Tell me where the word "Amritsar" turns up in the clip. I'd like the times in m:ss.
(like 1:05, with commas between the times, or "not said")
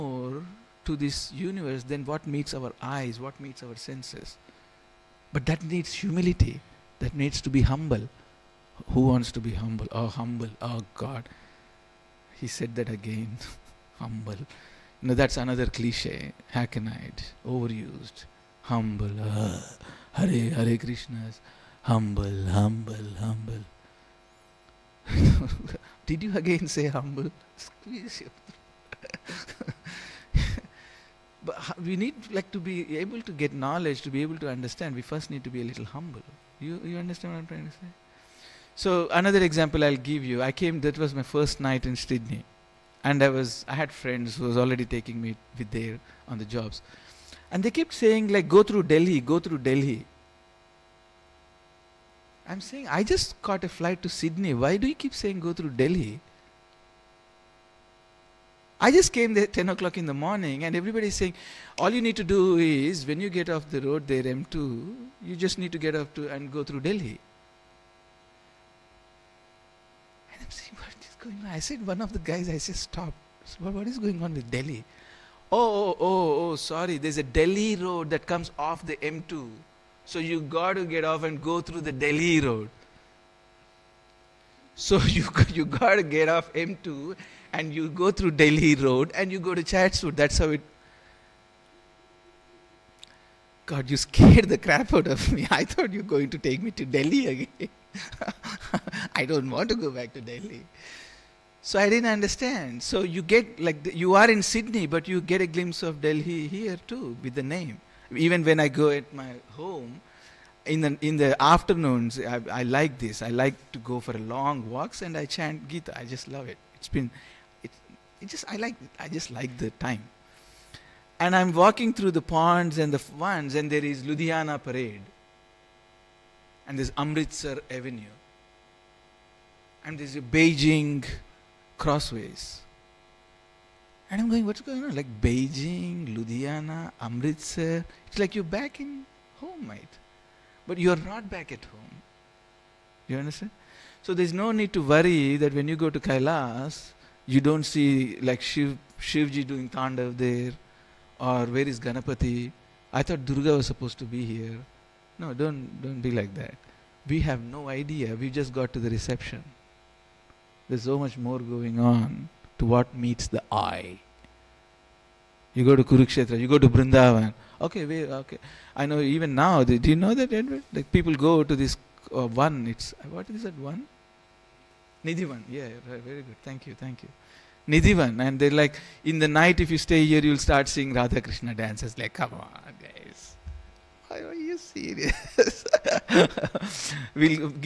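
2:06, 2:17.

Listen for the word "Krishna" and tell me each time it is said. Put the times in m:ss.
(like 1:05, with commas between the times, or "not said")
0:20, 3:01.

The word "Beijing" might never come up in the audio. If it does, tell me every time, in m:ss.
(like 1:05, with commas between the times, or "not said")
2:10, 2:15.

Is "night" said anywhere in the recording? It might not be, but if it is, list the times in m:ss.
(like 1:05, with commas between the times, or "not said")
0:41, 2:59.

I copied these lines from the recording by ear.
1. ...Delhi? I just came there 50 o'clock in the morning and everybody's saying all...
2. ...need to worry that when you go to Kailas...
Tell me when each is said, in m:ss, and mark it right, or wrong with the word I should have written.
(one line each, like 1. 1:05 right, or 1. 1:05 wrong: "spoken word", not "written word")
1. 0:55 wrong: "10", not "50"
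2. 2:24 right.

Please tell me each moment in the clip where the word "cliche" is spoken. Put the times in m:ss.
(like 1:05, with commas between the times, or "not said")
0:15.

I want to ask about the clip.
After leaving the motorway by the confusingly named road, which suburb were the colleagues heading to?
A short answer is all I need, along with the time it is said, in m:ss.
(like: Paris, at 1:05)
Chatswood, at 1:29.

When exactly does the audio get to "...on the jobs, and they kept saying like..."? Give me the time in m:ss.
0:46.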